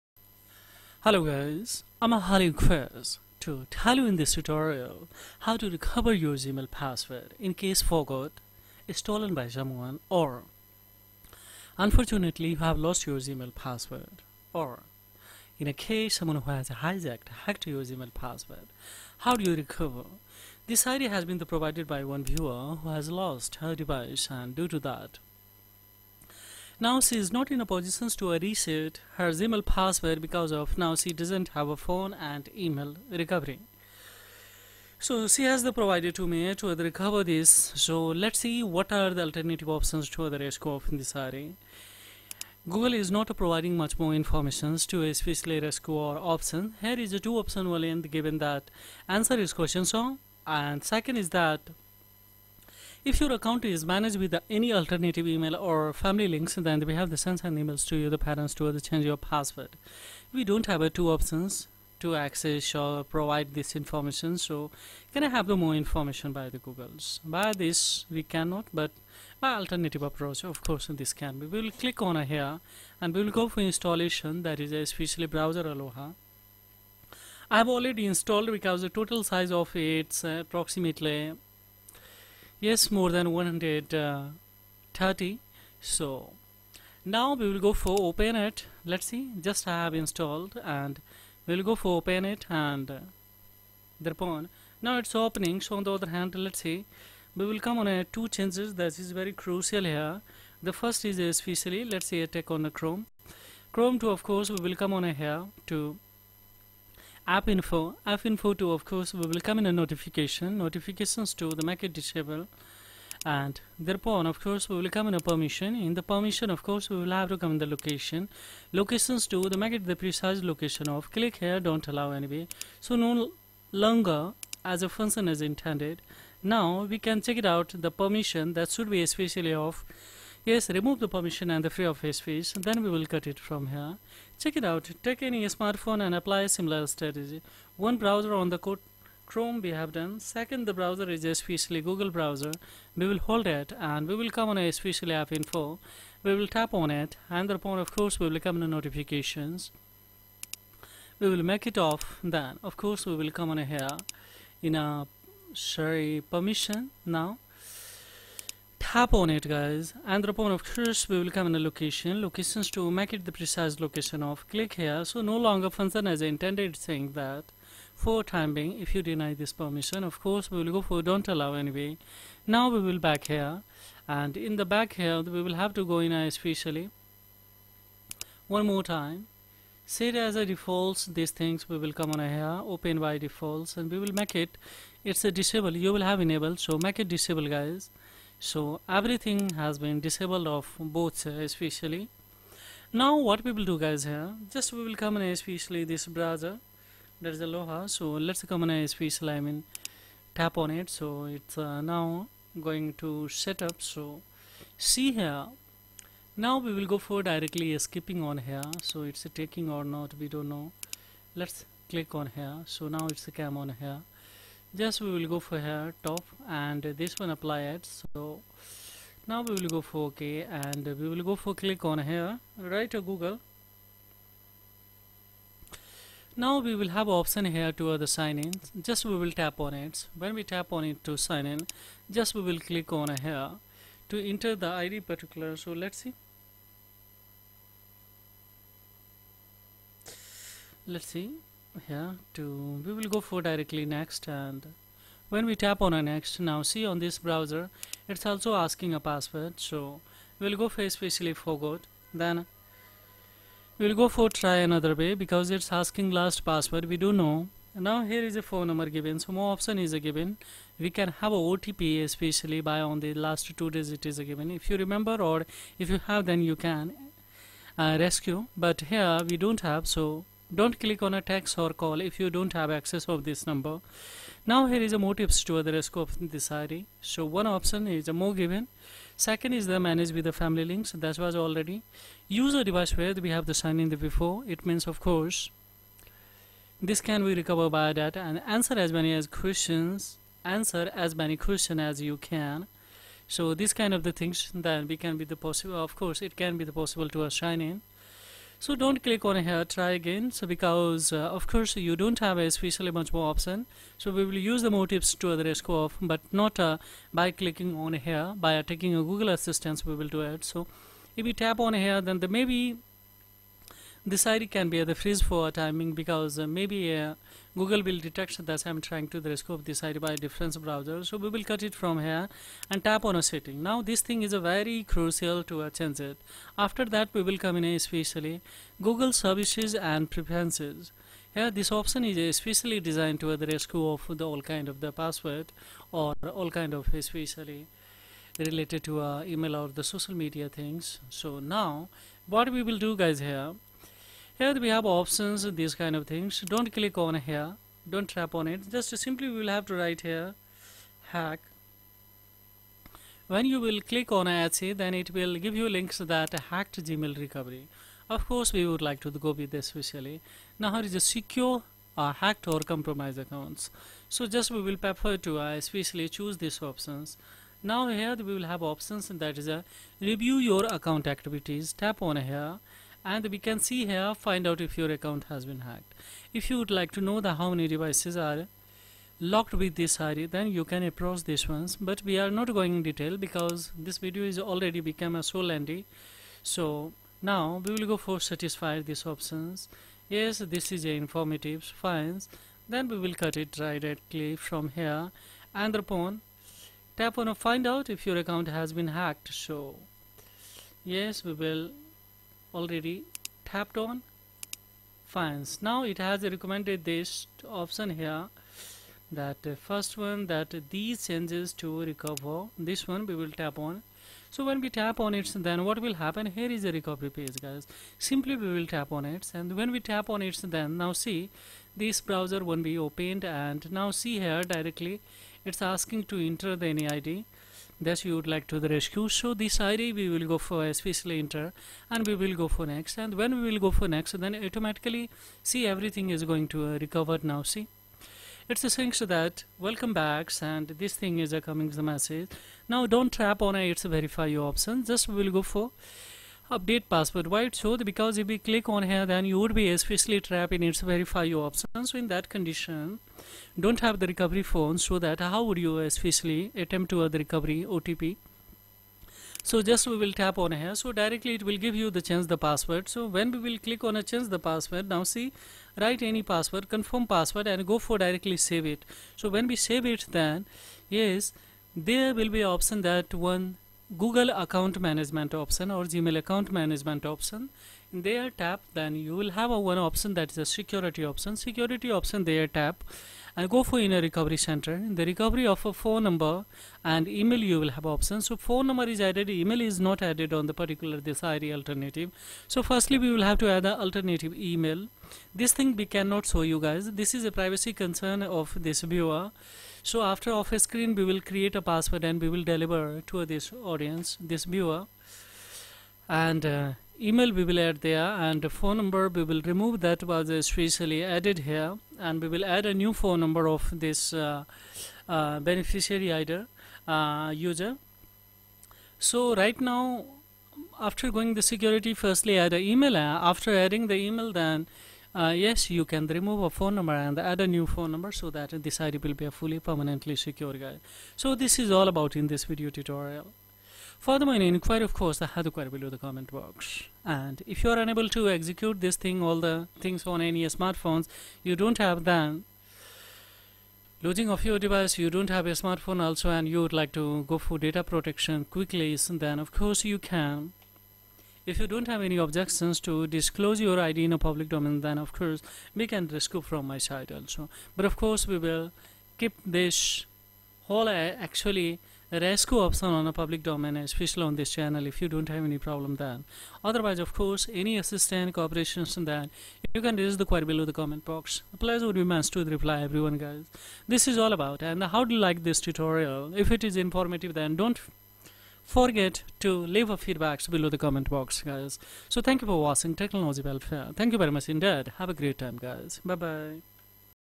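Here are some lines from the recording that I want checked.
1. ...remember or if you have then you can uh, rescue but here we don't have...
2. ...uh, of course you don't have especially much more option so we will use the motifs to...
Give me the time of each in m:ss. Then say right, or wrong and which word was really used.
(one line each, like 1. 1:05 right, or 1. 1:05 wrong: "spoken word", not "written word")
1. 4:24 right
2. 5:01 right.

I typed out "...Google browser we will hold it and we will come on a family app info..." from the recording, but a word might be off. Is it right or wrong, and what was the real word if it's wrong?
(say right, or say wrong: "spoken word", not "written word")
wrong: "especially", not "family".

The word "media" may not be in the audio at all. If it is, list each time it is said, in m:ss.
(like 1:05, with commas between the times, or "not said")
5:40.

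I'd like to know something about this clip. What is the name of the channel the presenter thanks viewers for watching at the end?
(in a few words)
Technology Welfare.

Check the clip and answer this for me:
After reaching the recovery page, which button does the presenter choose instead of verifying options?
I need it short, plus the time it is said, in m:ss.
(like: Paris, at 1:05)
update password, at 7:26.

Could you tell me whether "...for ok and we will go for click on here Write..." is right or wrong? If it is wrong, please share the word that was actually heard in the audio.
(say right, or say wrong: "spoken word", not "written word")
right.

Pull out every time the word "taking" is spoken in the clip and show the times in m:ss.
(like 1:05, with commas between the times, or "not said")
3:29, 5:08.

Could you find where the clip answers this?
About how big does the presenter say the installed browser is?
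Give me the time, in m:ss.
1:22.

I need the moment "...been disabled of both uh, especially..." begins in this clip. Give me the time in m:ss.
3:09.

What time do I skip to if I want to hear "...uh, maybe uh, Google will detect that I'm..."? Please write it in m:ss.
5:16.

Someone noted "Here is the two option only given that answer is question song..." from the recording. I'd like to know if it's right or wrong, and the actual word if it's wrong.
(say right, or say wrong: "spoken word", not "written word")
right.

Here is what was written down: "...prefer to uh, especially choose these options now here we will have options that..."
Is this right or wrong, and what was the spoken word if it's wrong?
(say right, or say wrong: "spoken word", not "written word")
right.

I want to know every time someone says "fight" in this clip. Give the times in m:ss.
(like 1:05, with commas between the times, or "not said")
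not said.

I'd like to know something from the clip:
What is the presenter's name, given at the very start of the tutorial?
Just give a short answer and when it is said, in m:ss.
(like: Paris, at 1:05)
Halu Chris, at 0:02.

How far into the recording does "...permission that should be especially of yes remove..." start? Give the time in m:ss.
2:07.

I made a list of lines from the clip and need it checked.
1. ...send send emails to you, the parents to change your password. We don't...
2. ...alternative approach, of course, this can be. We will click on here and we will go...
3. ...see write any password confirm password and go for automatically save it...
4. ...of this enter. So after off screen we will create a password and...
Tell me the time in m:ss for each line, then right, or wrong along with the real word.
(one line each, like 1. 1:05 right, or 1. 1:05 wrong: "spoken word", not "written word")
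1. 0:57 right
2. 1:09 right
3. 7:45 wrong: "directly", not "automatically"
4. 8:18 wrong: "viewer", not "enter".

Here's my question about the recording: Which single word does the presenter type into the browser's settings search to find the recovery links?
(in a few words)
hack.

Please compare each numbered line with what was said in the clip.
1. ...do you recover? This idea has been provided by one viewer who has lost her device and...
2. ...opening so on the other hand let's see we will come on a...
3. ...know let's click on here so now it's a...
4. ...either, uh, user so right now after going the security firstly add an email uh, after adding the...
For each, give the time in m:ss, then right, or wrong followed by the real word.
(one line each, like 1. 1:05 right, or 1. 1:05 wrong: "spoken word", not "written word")
1. 0:19 right
2. 1:35 right
3. 3:30 right
4. 8:36 right.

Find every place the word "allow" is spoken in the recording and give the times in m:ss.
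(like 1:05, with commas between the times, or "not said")
2:01, 2:51.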